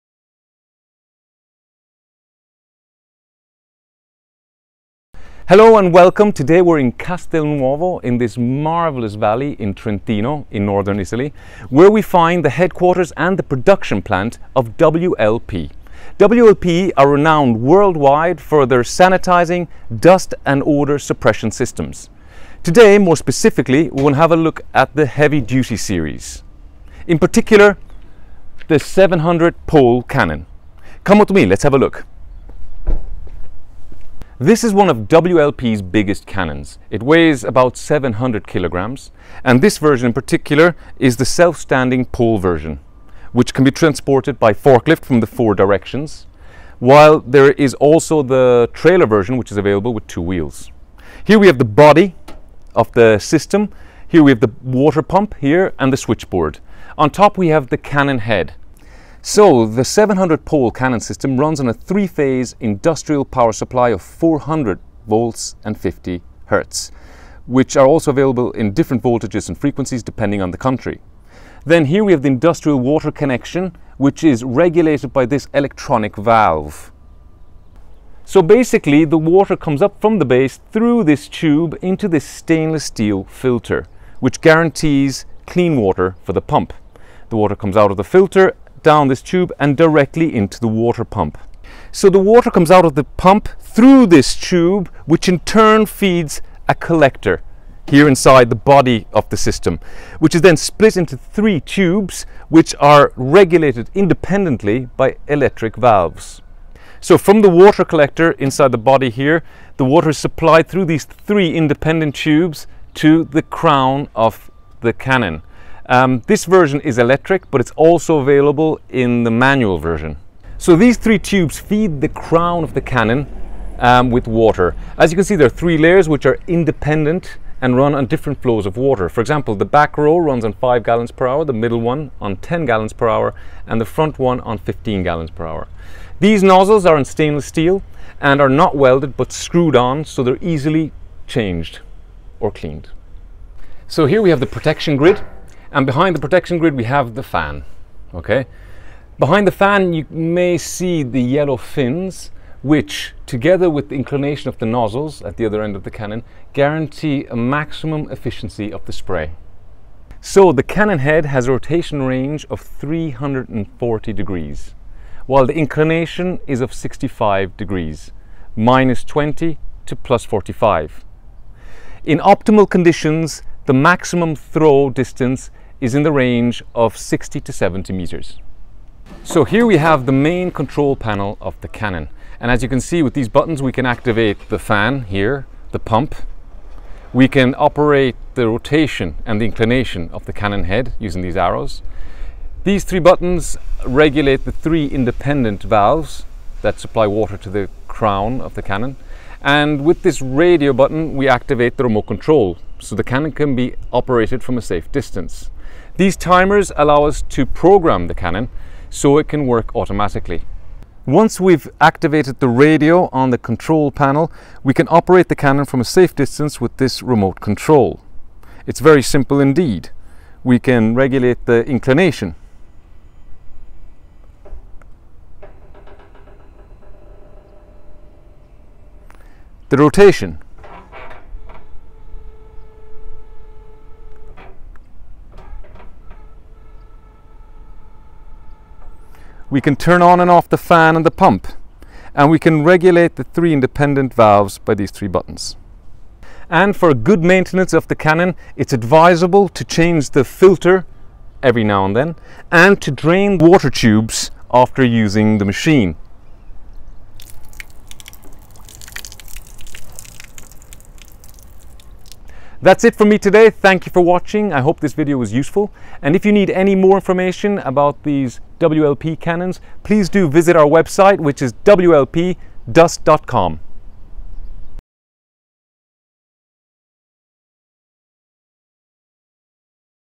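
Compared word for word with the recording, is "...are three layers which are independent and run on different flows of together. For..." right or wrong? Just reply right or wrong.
wrong.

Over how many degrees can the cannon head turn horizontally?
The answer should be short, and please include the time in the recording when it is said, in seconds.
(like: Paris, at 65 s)
340 degrees, at 162 s.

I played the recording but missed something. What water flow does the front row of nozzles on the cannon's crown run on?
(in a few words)
15 gallons per hour.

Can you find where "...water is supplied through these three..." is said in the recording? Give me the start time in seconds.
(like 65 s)
109 s.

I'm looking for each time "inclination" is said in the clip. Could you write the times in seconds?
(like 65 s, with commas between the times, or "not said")
153 s, 165 s, 189 s, 221 s.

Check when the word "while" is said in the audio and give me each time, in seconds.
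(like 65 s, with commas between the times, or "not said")
46 s, 165 s.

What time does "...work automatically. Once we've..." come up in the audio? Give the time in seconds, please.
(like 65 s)
209 s.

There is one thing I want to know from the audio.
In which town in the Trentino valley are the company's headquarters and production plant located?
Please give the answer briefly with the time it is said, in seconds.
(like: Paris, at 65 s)
Castelnuovo, at 6 s.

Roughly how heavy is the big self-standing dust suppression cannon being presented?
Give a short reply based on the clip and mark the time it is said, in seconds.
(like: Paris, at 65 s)
700 kilograms, at 37 s.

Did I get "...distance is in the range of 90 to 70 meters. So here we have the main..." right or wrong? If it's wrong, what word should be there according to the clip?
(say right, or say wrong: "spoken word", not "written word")
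wrong: "60", not "90".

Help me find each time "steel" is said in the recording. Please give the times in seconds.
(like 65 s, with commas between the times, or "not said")
82 s, 137 s.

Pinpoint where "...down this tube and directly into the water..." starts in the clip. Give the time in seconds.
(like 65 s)
88 s.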